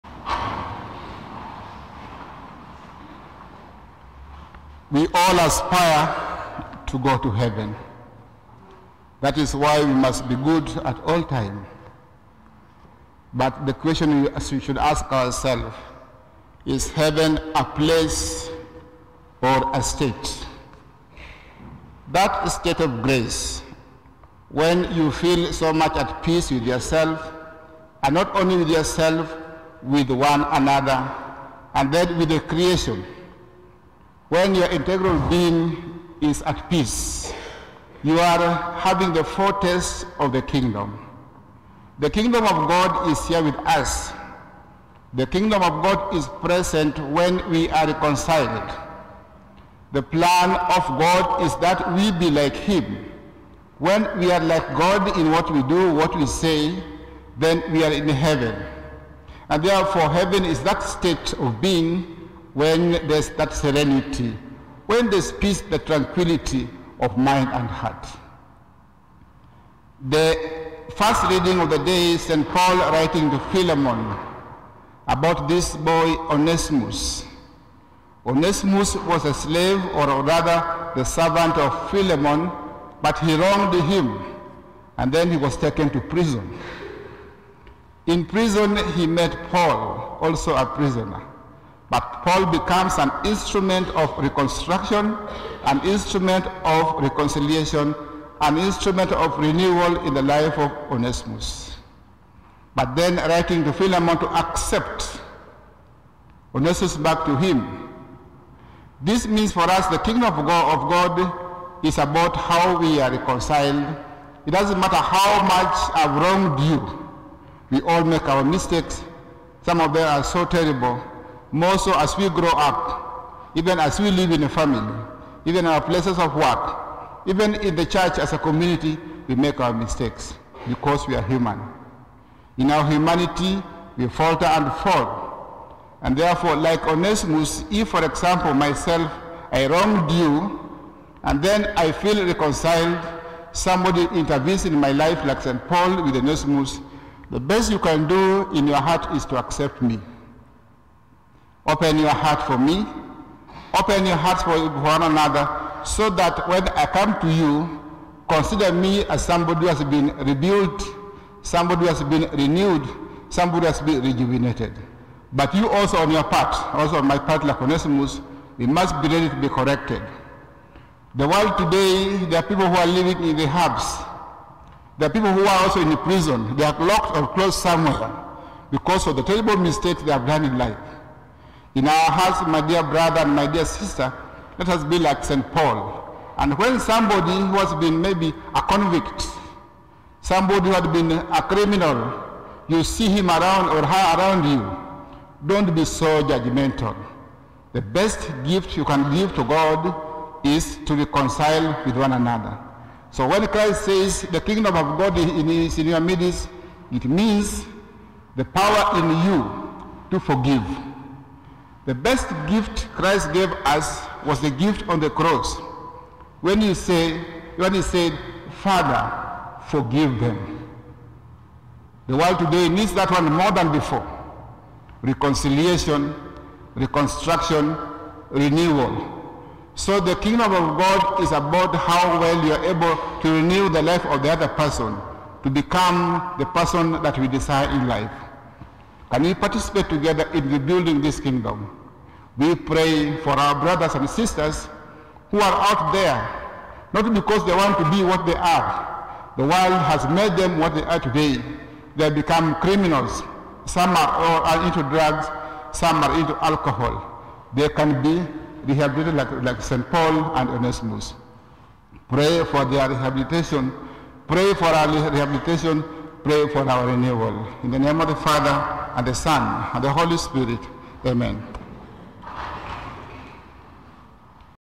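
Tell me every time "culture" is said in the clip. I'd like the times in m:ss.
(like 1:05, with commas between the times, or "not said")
not said.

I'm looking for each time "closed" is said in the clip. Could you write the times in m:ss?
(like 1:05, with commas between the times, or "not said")
2:57.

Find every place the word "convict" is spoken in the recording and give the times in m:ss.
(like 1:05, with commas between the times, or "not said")
3:08.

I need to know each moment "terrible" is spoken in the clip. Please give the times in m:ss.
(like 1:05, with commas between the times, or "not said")
2:00, 2:59.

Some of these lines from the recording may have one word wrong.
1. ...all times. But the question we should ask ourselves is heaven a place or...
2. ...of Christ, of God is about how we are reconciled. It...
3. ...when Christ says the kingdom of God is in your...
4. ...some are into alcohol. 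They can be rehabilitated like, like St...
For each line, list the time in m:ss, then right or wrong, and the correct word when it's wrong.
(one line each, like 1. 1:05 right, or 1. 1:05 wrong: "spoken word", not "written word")
1. 0:11 right
2. 1:50 wrong: "God", not "Christ"
3. 3:23 right
4. 4:15 right.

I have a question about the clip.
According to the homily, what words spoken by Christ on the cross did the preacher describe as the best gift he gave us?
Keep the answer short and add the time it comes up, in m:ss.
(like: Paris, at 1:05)
Father, forgive them, at 3:38.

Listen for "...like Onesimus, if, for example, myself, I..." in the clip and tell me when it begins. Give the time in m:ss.
2:16.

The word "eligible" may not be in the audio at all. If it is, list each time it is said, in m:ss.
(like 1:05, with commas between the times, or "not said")
not said.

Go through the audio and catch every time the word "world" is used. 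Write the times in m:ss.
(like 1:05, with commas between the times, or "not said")
2:51, 3:42, 4:09.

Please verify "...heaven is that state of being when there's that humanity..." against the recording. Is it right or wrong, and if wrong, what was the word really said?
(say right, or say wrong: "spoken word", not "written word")
wrong: "serenity", not "humanity".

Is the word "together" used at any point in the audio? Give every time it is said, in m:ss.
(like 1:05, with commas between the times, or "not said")
3:59.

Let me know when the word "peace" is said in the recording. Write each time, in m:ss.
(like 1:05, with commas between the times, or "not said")
0:26, 0:36, 1:05.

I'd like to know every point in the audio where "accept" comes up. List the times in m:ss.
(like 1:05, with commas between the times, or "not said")
1:44, 2:29.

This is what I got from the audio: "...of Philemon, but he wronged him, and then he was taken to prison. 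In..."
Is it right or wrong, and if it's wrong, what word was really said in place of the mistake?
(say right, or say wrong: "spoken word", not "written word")
right.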